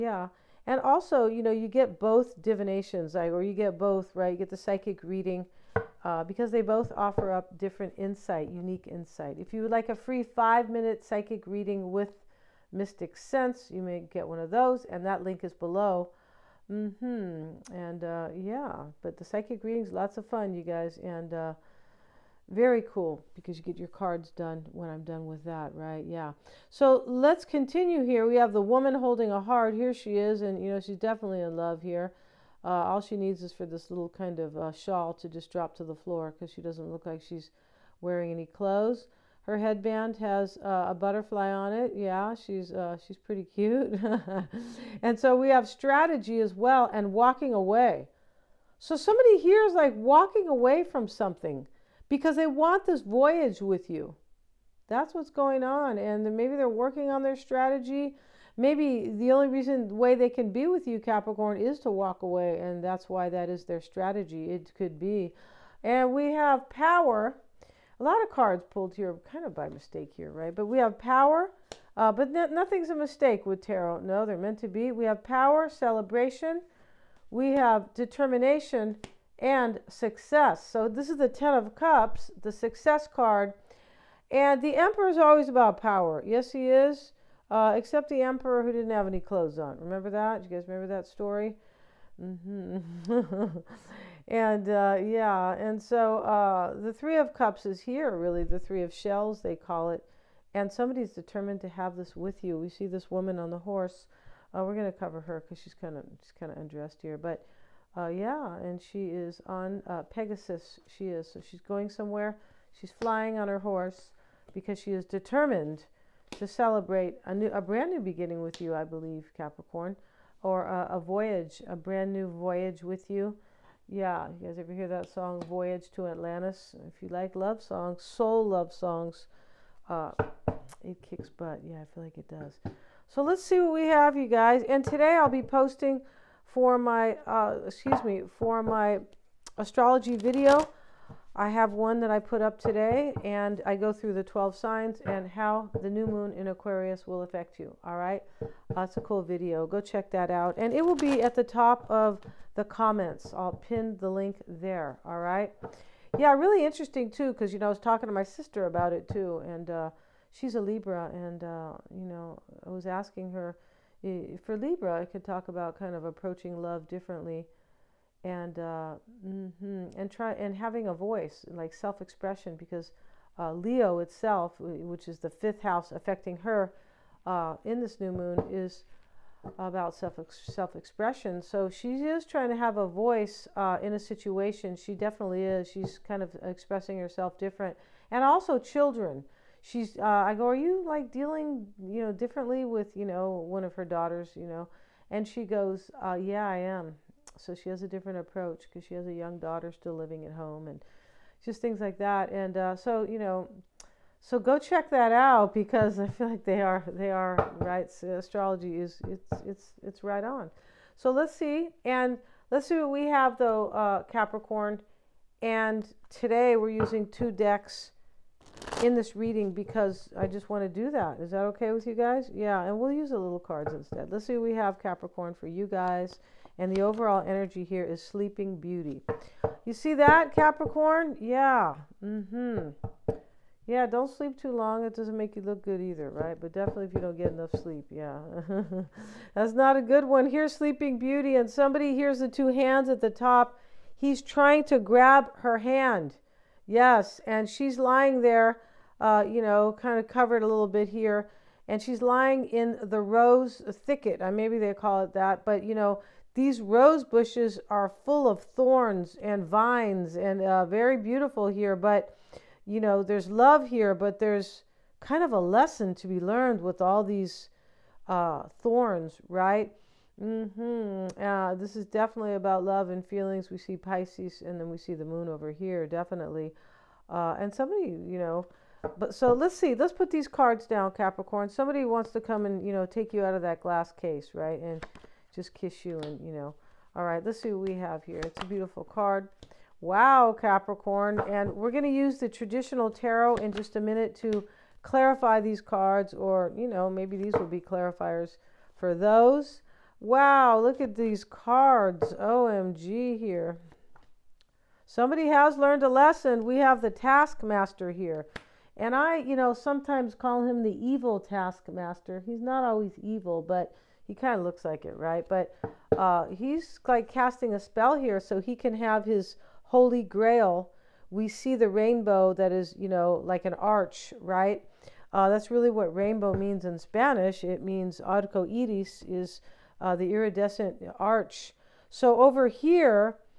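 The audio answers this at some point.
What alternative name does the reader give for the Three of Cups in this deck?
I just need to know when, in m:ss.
1:38.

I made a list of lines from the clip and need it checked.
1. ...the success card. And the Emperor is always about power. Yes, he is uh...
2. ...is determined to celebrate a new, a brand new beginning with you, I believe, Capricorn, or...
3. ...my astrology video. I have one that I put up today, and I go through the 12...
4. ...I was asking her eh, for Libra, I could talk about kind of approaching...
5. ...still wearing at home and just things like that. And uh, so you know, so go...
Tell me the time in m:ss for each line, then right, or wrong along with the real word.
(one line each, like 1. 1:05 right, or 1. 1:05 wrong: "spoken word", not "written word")
1. 1:22 right
2. 1:54 right
3. 2:18 right
4. 2:42 right
5. 3:19 wrong: "living", not "wearing".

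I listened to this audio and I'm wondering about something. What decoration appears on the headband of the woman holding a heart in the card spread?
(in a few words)
A butterfly.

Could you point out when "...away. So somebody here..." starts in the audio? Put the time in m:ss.
0:47.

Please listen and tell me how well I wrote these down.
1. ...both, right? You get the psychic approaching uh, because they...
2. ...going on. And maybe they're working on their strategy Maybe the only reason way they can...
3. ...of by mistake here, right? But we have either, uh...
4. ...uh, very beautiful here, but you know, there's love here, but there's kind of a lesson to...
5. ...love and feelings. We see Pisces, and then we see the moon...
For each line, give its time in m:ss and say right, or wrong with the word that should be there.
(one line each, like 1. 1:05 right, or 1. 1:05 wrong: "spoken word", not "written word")
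1. 0:03 wrong: "reading", not "approaching"
2. 0:55 right
3. 1:09 wrong: "power", not "either"
4. 4:20 right
5. 4:32 right.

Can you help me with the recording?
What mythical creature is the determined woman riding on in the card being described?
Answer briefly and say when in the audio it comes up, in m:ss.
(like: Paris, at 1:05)
Pegasus, at 1:50.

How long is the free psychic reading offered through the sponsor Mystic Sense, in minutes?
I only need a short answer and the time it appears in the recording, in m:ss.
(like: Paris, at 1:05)
5, at 0:10.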